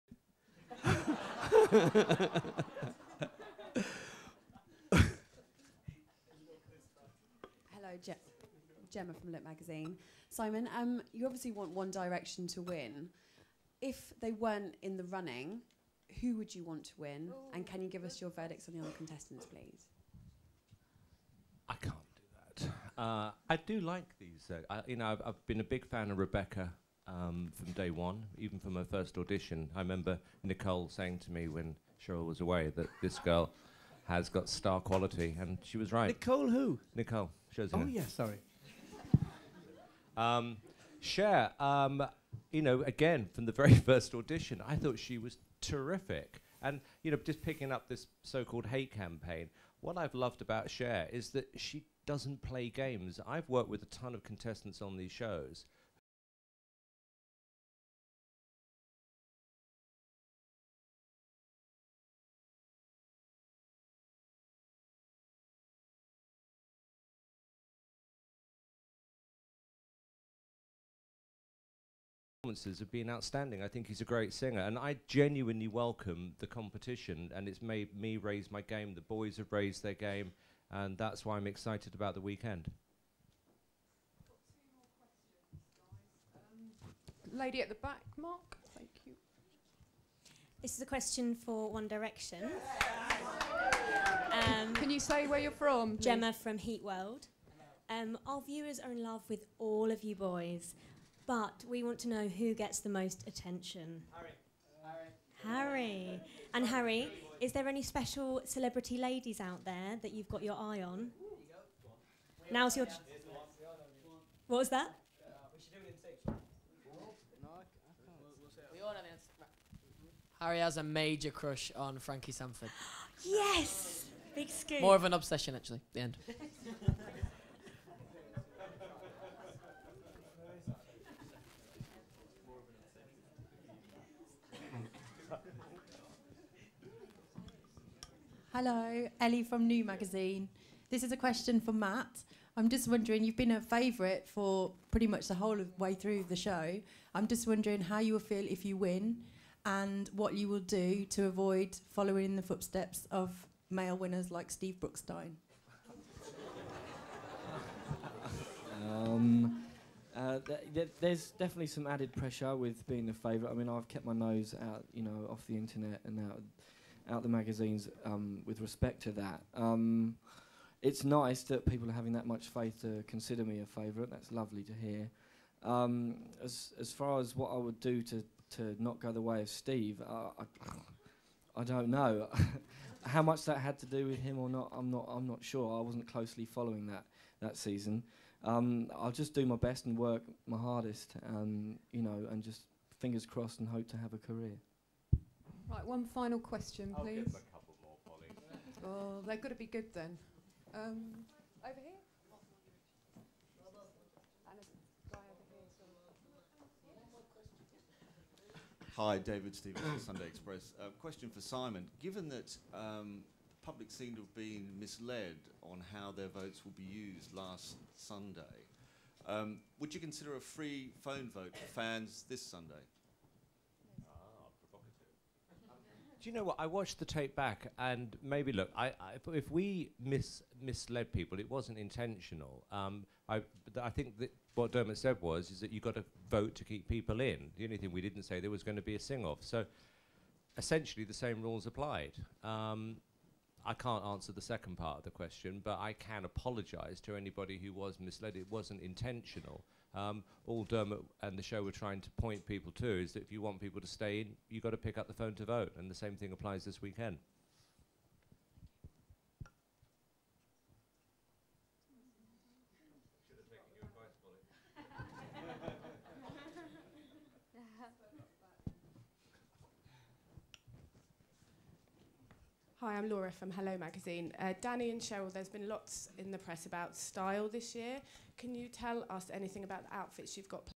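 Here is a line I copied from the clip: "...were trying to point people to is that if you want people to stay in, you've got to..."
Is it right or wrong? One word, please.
right.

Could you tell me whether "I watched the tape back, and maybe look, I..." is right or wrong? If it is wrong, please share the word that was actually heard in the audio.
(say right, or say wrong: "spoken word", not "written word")
right.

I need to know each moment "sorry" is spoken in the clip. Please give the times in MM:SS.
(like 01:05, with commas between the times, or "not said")
00:38.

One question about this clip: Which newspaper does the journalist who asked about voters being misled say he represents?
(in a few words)
Sunday Express.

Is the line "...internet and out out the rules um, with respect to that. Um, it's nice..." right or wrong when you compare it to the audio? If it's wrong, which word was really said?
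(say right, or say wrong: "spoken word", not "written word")
wrong: "magazines", not "rules".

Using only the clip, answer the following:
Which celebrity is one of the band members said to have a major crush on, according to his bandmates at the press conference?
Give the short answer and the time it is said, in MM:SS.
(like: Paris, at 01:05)
Frankie Sandford, at 02:01.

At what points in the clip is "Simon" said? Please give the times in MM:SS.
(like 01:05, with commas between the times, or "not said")
00:10, 03:31.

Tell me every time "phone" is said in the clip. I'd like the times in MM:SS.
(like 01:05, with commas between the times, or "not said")
03:41, 04:15.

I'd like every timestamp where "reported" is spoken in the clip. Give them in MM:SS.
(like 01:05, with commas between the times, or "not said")
not said.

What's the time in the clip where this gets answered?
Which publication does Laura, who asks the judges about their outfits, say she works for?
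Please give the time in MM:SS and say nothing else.
04:33.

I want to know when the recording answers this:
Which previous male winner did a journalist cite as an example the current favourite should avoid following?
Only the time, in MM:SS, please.
02:34.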